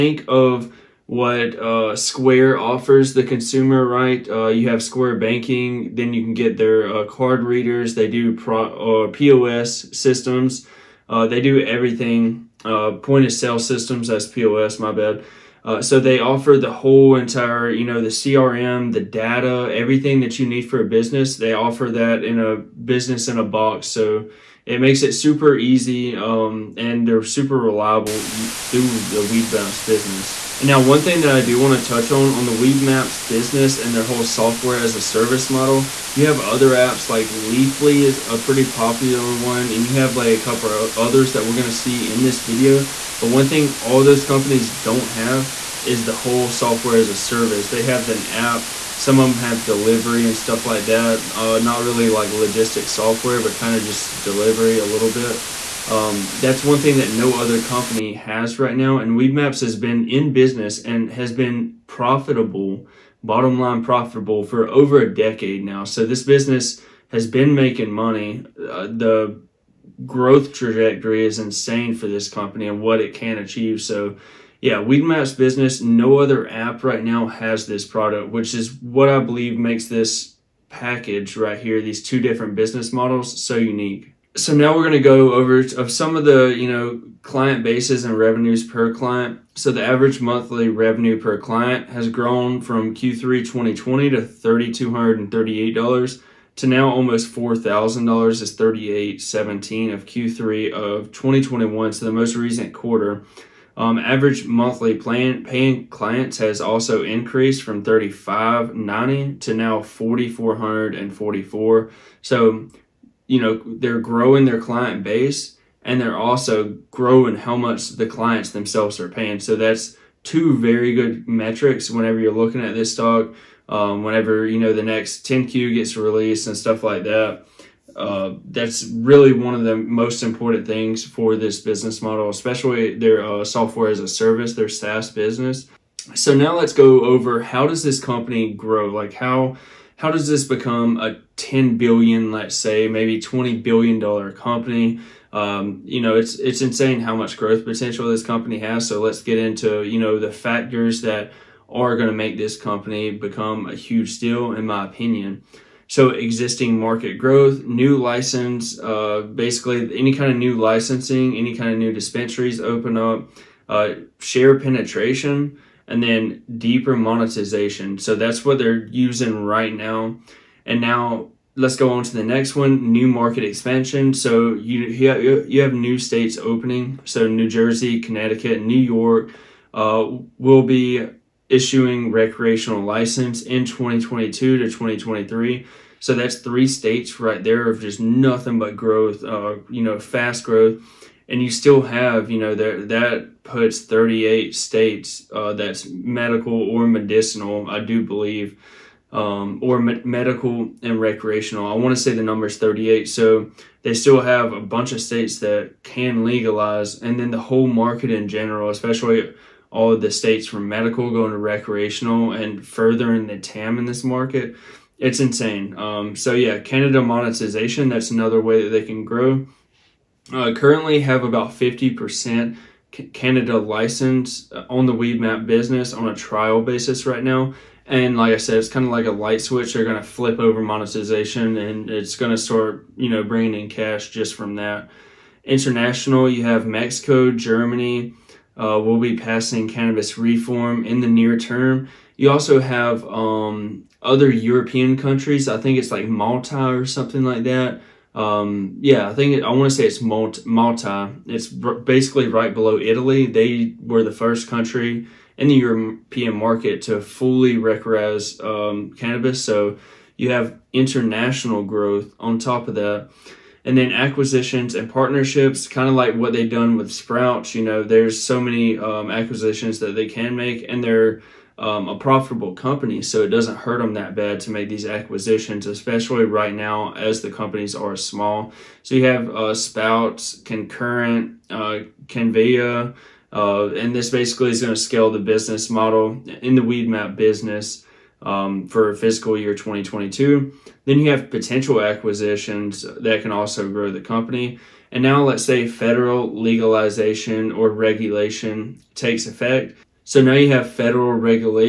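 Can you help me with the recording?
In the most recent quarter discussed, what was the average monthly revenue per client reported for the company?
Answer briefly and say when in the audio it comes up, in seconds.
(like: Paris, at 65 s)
$3,817, at 98 s.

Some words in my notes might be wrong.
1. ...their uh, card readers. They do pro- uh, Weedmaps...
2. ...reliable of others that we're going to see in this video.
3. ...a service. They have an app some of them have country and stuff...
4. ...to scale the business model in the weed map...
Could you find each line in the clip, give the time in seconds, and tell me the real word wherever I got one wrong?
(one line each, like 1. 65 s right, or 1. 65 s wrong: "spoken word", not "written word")
1. 6 s wrong: "POS", not "Weedmaps"
2. 40 s wrong: "couple", not "reliable"
3. 47 s wrong: "delivery", not "country"
4. 284 s right.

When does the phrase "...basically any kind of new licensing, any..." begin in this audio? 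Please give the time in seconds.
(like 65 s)
159 s.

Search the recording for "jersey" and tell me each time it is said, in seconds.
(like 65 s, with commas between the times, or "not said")
177 s.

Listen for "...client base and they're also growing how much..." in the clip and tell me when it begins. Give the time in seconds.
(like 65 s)
114 s.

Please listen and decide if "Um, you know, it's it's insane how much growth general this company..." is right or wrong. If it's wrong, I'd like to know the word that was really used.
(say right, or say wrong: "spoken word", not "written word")
wrong: "potential", not "general".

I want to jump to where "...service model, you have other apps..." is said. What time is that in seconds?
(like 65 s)
35 s.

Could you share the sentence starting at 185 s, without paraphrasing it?
So that's three states right there of just nothing but growth, uh, you know, fast growth.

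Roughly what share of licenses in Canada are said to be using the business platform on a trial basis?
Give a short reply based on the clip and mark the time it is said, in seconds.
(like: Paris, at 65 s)
50%, at 221 s.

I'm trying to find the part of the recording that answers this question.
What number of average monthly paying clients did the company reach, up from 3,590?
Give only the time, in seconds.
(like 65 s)
109 s.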